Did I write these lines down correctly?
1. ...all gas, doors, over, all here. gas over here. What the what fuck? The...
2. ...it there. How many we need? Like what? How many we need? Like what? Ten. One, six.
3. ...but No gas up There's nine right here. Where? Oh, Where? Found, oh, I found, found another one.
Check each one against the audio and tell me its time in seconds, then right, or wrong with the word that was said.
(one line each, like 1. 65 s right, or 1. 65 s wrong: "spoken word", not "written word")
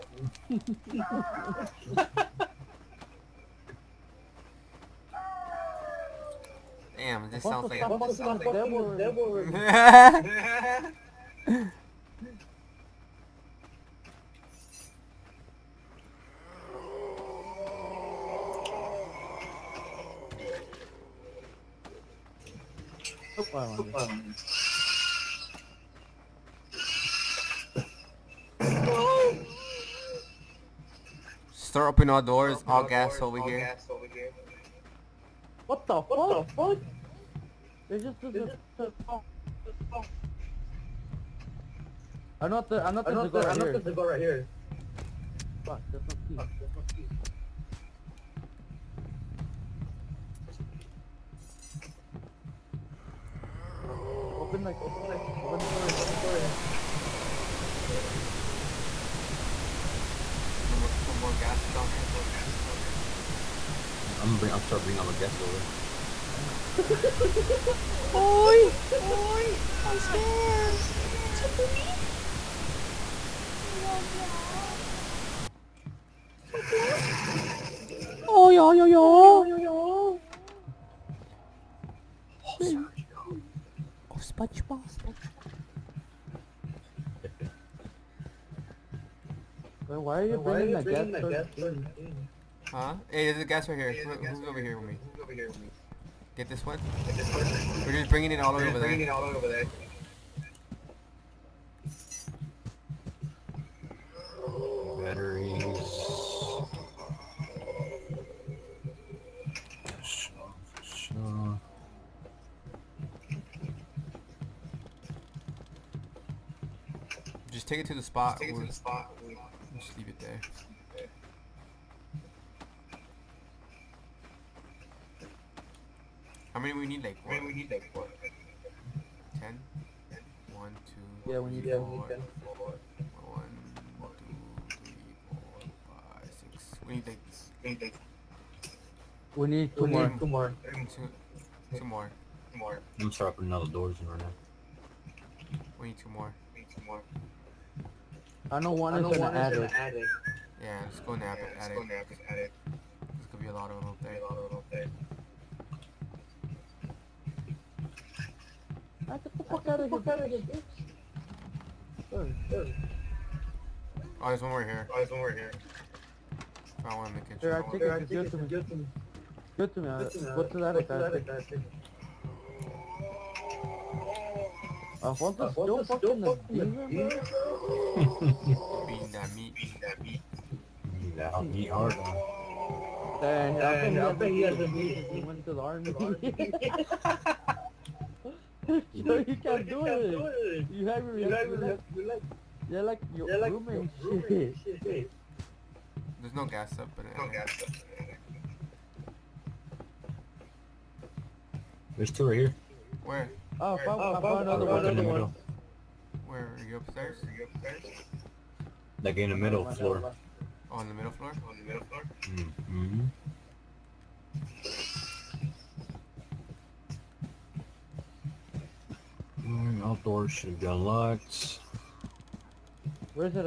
1. 32 s right
2. 120 s wrong: "two", not "six"
3. 196 s wrong: "two", not "nine".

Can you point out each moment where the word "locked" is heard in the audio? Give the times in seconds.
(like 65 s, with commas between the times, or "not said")
220 s.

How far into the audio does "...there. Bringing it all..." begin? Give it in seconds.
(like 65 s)
98 s.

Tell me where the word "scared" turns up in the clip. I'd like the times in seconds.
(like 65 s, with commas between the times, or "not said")
69 s.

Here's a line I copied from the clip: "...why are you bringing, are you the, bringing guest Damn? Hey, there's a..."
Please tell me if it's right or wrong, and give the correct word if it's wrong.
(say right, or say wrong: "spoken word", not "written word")
wrong: "Huh", not "Damn".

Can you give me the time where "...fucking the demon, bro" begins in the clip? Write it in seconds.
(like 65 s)
175 s.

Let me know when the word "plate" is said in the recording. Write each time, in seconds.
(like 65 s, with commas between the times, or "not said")
not said.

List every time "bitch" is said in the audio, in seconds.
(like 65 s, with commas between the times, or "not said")
160 s.